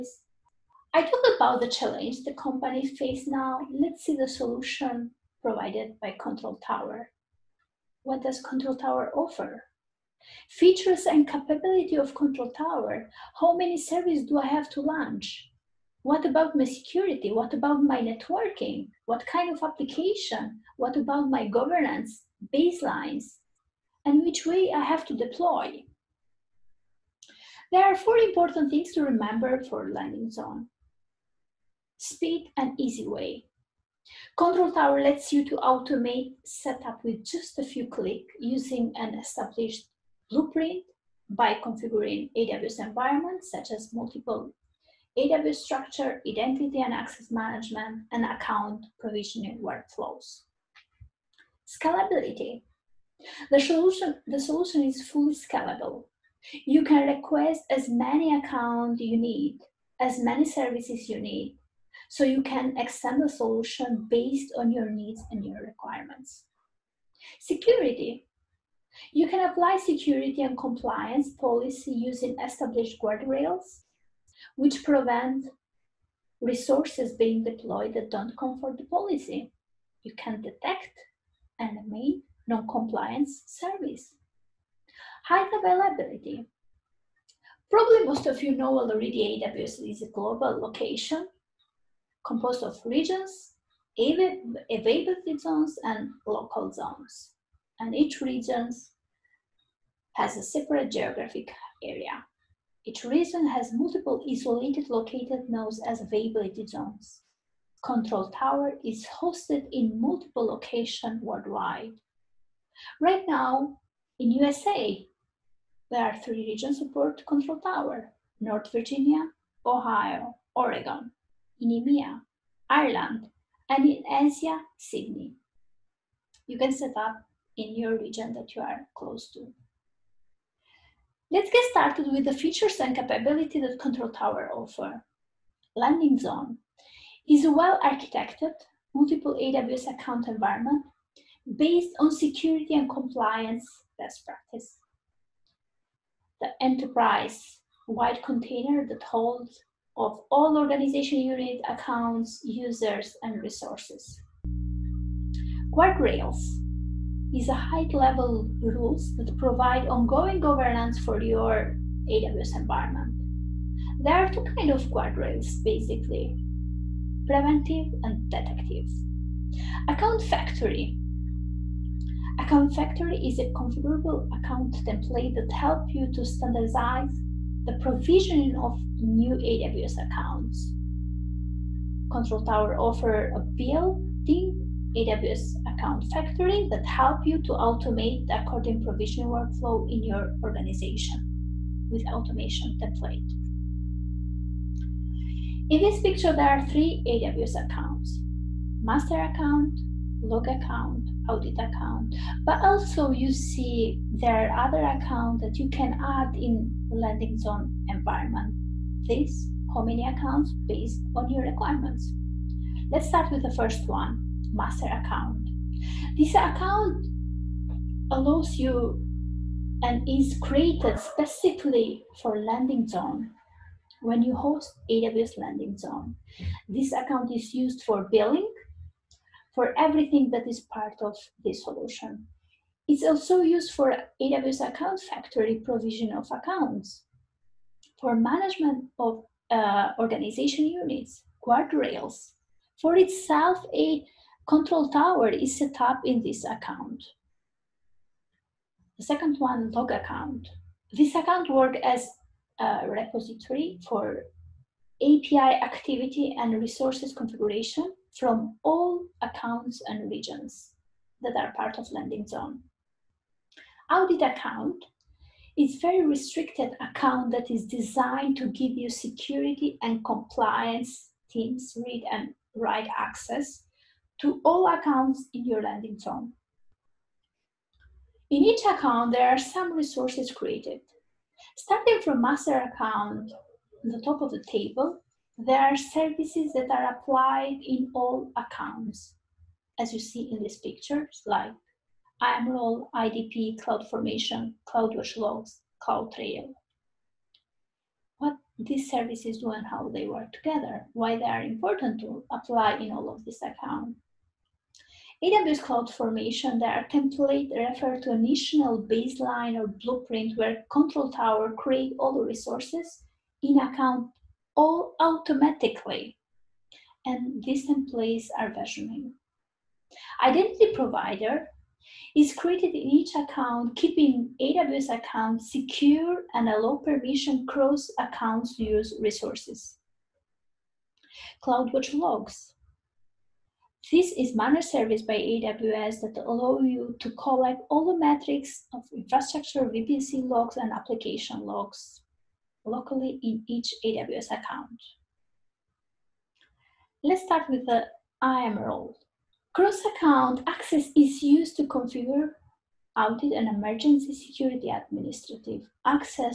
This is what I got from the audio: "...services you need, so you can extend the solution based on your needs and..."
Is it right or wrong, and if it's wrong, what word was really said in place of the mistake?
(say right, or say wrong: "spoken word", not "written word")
right.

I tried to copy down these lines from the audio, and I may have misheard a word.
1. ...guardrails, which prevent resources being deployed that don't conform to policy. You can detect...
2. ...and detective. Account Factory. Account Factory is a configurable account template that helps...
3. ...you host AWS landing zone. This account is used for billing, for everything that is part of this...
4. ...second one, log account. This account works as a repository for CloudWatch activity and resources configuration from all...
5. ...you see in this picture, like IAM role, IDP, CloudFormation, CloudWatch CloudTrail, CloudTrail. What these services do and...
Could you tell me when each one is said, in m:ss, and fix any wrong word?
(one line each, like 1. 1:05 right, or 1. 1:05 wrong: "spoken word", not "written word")
1. 1:13 right
2. 2:48 right
3. 3:44 right
4. 4:09 wrong: "API", not "CloudWatch"
5. 4:49 wrong: "Logs", not "CloudTrail".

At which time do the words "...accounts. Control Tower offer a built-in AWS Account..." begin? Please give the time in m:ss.
3:00.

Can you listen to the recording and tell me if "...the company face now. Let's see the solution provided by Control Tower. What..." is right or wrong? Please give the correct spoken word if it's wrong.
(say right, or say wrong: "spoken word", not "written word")
right.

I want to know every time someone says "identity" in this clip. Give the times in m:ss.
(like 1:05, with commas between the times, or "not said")
0:46, 5:20.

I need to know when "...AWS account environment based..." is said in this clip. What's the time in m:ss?
2:19.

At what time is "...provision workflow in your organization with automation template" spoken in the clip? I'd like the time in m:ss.
3:08.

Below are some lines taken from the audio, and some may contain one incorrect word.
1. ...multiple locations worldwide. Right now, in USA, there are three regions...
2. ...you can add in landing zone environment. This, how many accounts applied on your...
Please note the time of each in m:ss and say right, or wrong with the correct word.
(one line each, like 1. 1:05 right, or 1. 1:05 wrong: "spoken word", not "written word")
1. 1:49 right
2. 3:25 wrong: "based", not "applied".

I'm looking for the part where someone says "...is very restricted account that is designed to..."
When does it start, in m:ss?
4:25.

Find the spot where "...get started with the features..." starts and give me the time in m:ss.
2:11.